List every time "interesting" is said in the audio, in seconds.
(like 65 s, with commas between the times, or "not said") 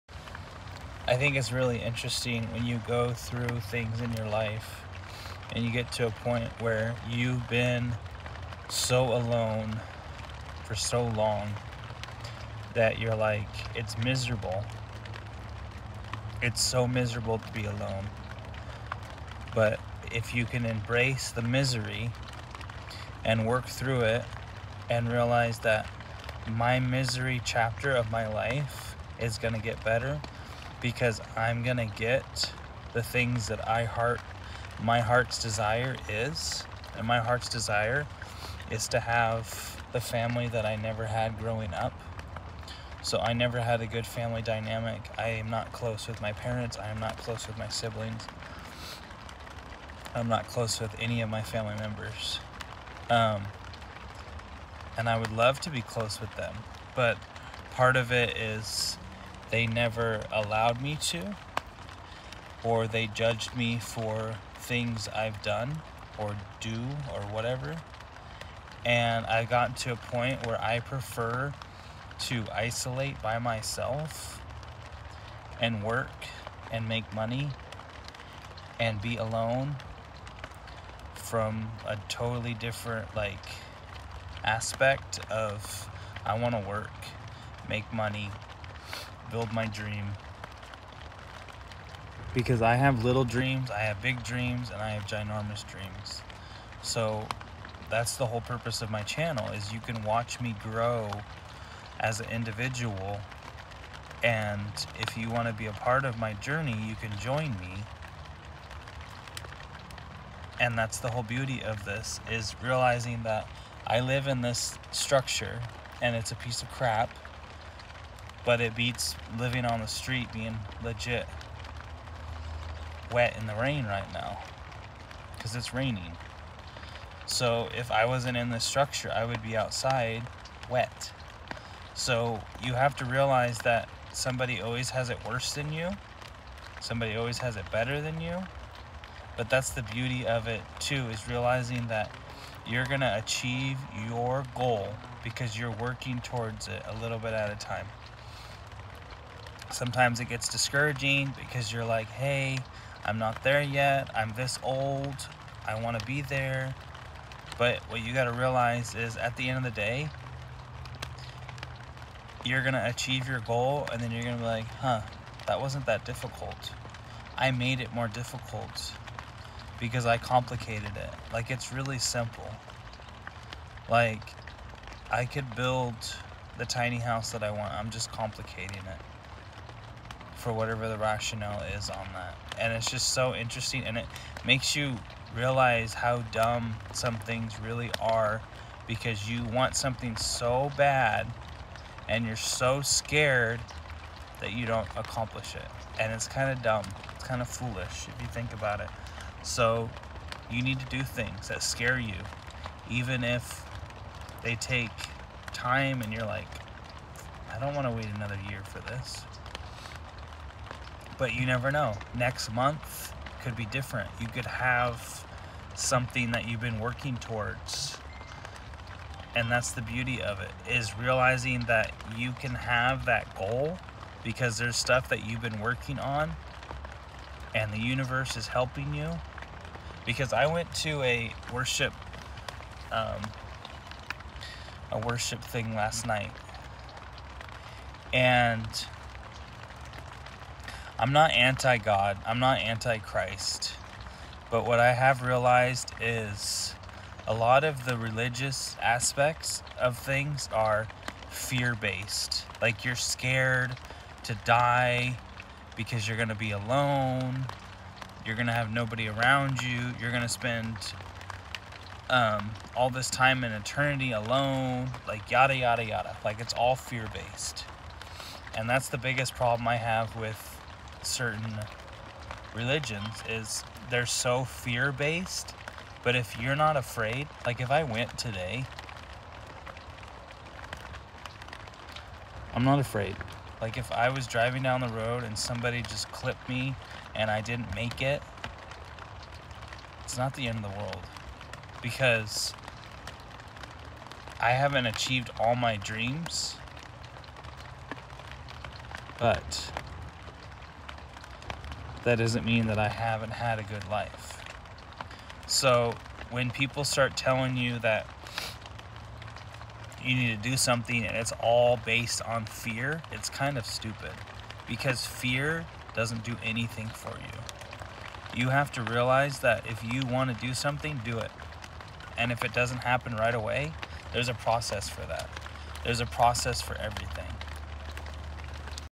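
1 s, 183 s.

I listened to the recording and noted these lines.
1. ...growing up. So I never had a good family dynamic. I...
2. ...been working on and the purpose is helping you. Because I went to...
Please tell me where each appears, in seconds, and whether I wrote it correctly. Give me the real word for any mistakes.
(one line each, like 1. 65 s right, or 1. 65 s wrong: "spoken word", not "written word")
1. 41 s right
2. 225 s wrong: "universe", not "purpose".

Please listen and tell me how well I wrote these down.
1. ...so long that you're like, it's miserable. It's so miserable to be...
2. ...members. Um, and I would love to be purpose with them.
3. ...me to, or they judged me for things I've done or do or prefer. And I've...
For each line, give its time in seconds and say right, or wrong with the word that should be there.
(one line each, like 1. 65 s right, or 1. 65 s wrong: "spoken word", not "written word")
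1. 10 s right
2. 51 s wrong: "close", not "purpose"
3. 60 s wrong: "whatever", not "prefer".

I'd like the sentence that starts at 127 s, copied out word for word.
So if I wasn't in this structure, I would be outside wet.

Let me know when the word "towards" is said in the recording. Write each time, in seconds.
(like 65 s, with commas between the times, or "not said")
146 s, 217 s.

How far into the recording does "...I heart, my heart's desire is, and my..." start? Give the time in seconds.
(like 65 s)
33 s.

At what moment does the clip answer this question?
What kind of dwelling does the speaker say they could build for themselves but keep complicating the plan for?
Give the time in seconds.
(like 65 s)
176 s.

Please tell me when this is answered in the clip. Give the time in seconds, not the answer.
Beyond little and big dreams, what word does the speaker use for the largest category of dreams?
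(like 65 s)
95 s.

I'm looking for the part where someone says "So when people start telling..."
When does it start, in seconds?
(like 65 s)
305 s.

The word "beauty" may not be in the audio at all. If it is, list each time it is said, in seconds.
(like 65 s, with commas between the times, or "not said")
111 s, 139 s, 219 s.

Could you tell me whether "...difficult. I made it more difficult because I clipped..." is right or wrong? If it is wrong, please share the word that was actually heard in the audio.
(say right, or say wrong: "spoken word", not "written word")
wrong: "complicated", not "clipped".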